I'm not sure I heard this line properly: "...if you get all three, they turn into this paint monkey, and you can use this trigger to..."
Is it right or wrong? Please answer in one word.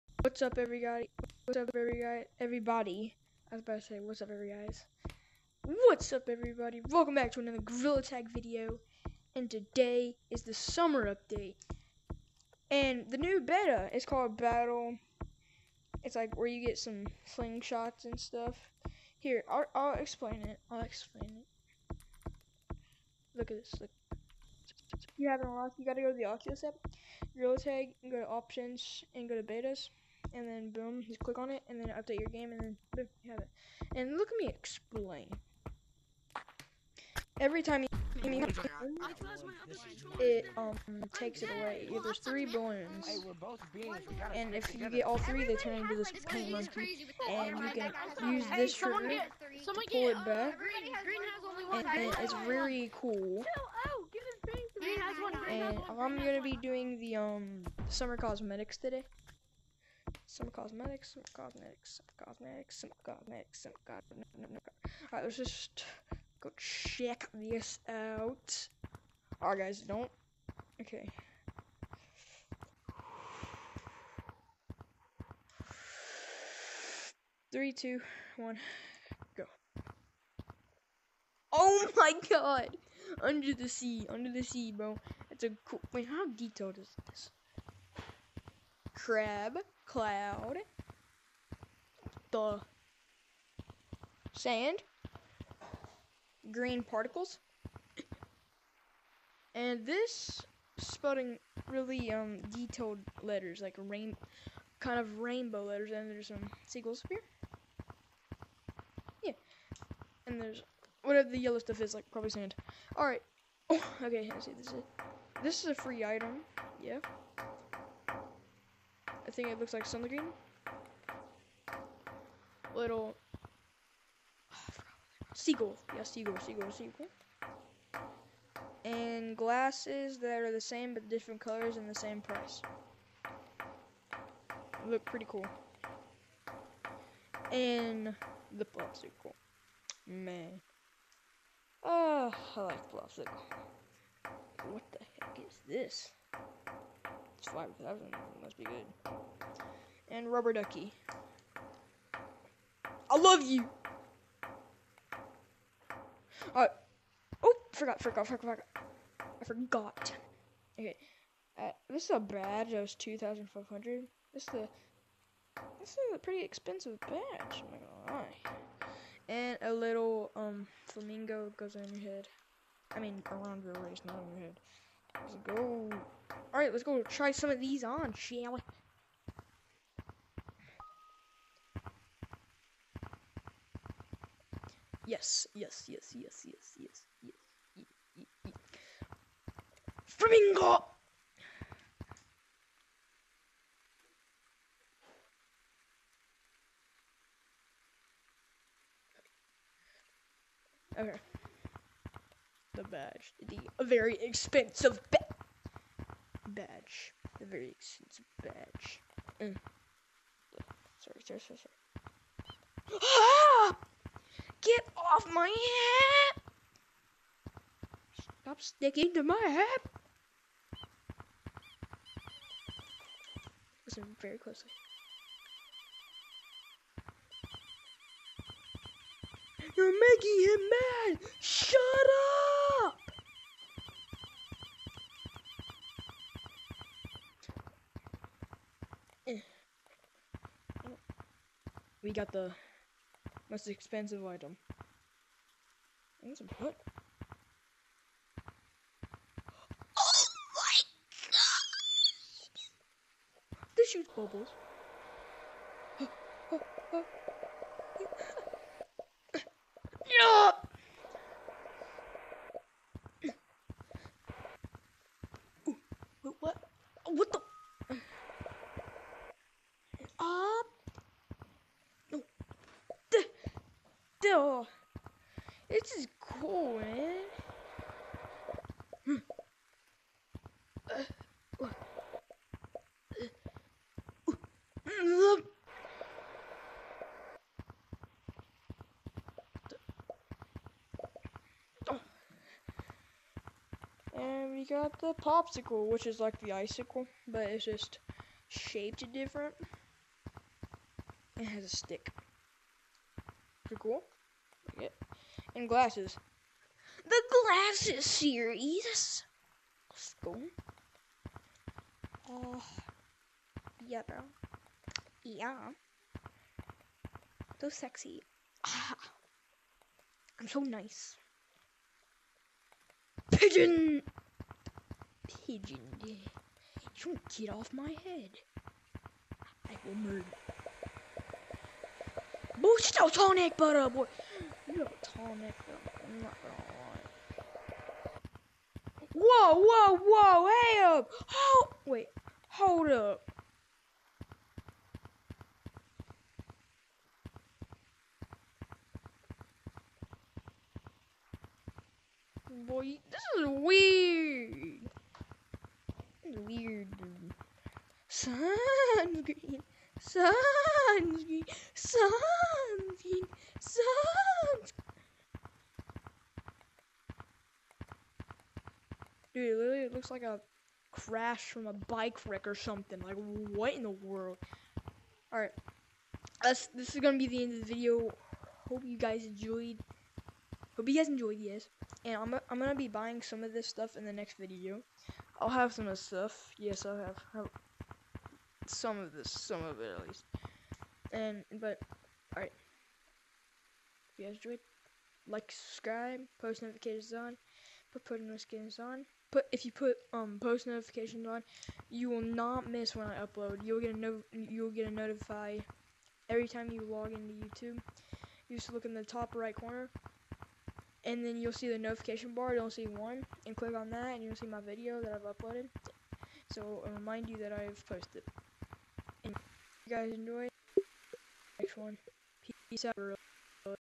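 right.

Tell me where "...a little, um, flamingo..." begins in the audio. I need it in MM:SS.
02:49.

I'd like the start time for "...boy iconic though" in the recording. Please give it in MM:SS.
05:33.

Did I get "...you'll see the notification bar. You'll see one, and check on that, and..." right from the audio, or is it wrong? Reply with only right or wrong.
wrong.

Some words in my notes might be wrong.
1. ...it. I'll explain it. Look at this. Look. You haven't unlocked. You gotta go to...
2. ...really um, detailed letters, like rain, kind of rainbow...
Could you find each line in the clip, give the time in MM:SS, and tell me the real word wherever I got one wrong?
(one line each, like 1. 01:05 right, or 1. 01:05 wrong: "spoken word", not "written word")
1. 00:20 right
2. 01:41 right.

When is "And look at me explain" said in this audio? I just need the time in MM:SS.
00:33.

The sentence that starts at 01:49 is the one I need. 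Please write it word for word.
Yeah, and there's whatever the yellow stuff is, like probably sand.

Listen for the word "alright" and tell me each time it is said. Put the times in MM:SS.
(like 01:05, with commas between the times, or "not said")
01:05, 01:09, 02:56, 06:15, 06:32.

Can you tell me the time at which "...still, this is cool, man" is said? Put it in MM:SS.
04:34.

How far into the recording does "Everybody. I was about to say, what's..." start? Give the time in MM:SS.
00:02.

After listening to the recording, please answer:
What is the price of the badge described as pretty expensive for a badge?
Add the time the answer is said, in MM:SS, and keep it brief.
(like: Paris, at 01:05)
2,500, at 02:42.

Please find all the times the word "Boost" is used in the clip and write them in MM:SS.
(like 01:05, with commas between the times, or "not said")
05:32.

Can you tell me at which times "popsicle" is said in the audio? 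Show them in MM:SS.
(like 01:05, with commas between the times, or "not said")
02:18, 02:22, 04:55.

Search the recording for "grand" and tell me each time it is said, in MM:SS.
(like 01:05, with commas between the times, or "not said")
not said.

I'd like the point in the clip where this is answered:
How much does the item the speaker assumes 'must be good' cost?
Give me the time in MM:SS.
02:27.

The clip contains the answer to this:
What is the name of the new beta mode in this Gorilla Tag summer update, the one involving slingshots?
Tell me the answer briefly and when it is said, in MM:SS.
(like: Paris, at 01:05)
Battle, at 00:14.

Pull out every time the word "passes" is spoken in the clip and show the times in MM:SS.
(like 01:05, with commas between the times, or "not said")
not said.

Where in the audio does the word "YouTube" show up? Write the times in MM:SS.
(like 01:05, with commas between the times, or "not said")
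06:47.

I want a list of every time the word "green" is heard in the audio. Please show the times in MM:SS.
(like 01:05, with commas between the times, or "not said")
01:36, 02:00.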